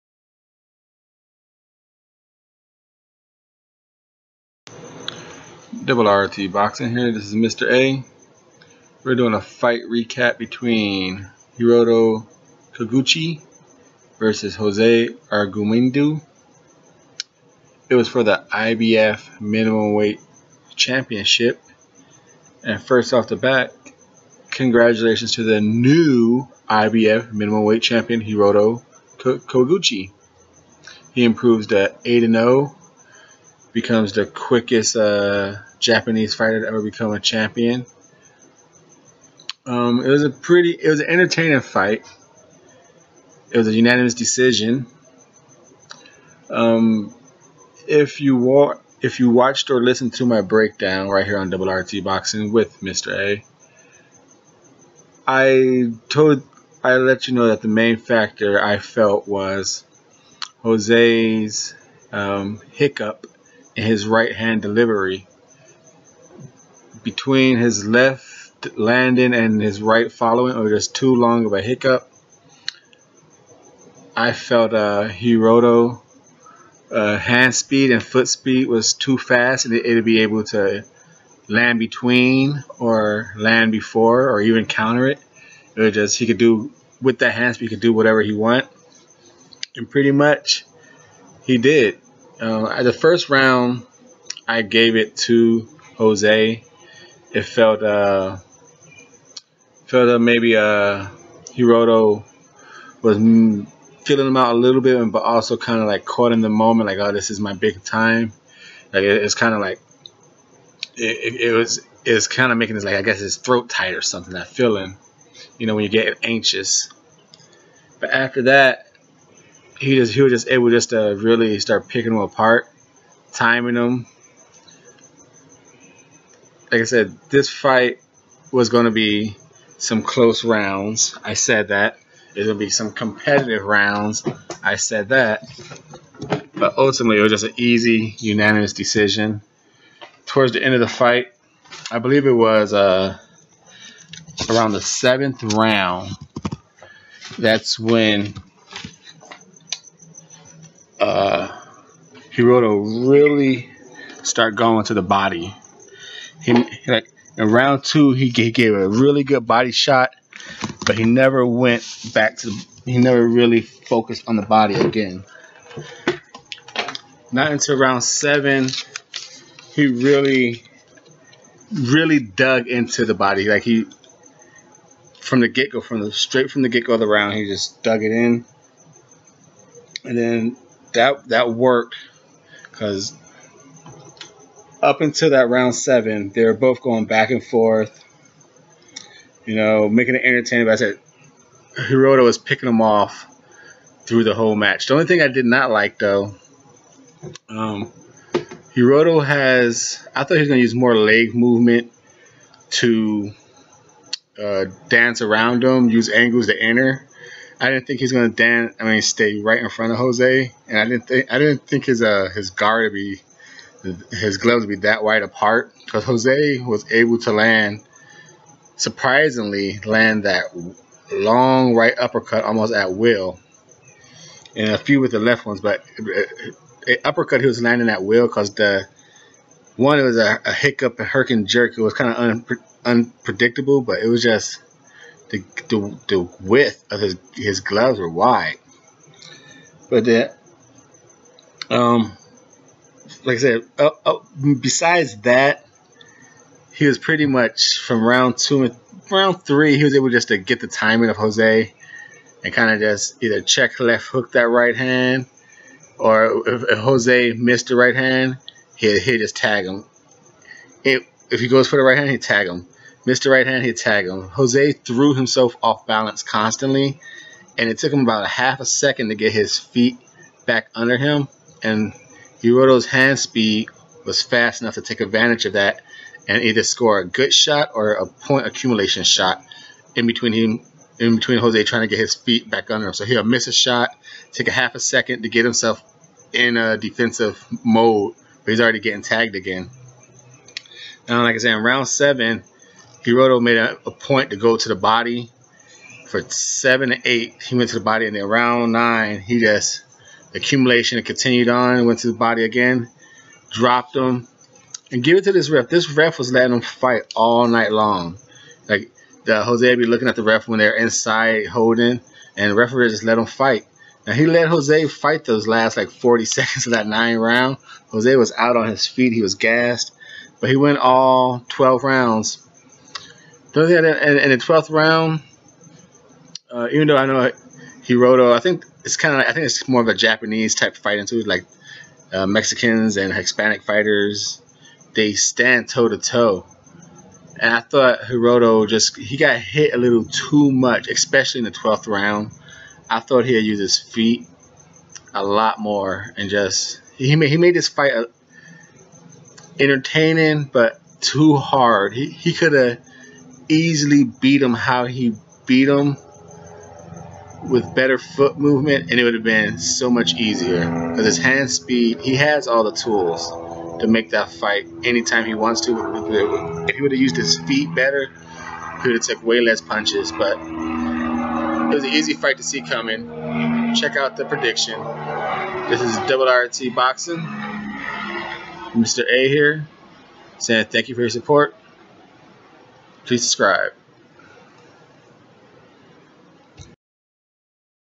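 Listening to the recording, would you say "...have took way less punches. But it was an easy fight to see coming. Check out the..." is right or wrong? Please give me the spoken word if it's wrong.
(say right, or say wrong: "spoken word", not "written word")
right.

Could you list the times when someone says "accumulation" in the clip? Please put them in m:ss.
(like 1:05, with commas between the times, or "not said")
4:38, 5:00.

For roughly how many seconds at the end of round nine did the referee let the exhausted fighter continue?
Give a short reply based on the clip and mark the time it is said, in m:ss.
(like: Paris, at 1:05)
40, at 5:15.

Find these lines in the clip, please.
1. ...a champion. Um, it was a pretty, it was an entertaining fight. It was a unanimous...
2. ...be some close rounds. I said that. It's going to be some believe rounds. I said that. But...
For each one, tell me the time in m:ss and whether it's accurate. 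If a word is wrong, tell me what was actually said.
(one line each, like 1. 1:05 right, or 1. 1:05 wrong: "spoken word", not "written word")
1. 0:37 right
2. 2:08 wrong: "competitive", not "believe".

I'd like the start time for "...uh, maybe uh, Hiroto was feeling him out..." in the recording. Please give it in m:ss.
1:40.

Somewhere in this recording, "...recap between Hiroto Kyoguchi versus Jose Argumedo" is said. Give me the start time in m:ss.
0:09.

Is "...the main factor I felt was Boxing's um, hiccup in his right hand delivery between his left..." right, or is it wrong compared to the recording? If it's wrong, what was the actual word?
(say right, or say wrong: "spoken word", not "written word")
wrong: "Jose", not "Boxing".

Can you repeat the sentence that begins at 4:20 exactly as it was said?
It, if he goes for the right hand, he tag him.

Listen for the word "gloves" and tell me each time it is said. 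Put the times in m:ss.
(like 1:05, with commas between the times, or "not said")
3:34, 3:57.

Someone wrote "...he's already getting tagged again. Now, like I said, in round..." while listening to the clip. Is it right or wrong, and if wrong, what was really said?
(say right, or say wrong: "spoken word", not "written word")
right.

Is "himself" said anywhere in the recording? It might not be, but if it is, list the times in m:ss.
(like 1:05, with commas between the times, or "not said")
4:25, 4:45.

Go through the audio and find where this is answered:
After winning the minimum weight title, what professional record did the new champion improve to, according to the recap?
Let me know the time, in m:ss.
0:32.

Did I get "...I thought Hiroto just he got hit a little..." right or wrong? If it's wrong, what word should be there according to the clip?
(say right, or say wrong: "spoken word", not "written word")
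right.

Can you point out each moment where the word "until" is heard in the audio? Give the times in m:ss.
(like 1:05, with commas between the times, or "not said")
2:47, 3:05.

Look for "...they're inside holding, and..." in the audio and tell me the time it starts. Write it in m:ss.
5:10.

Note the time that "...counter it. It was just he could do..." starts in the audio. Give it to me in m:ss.
1:24.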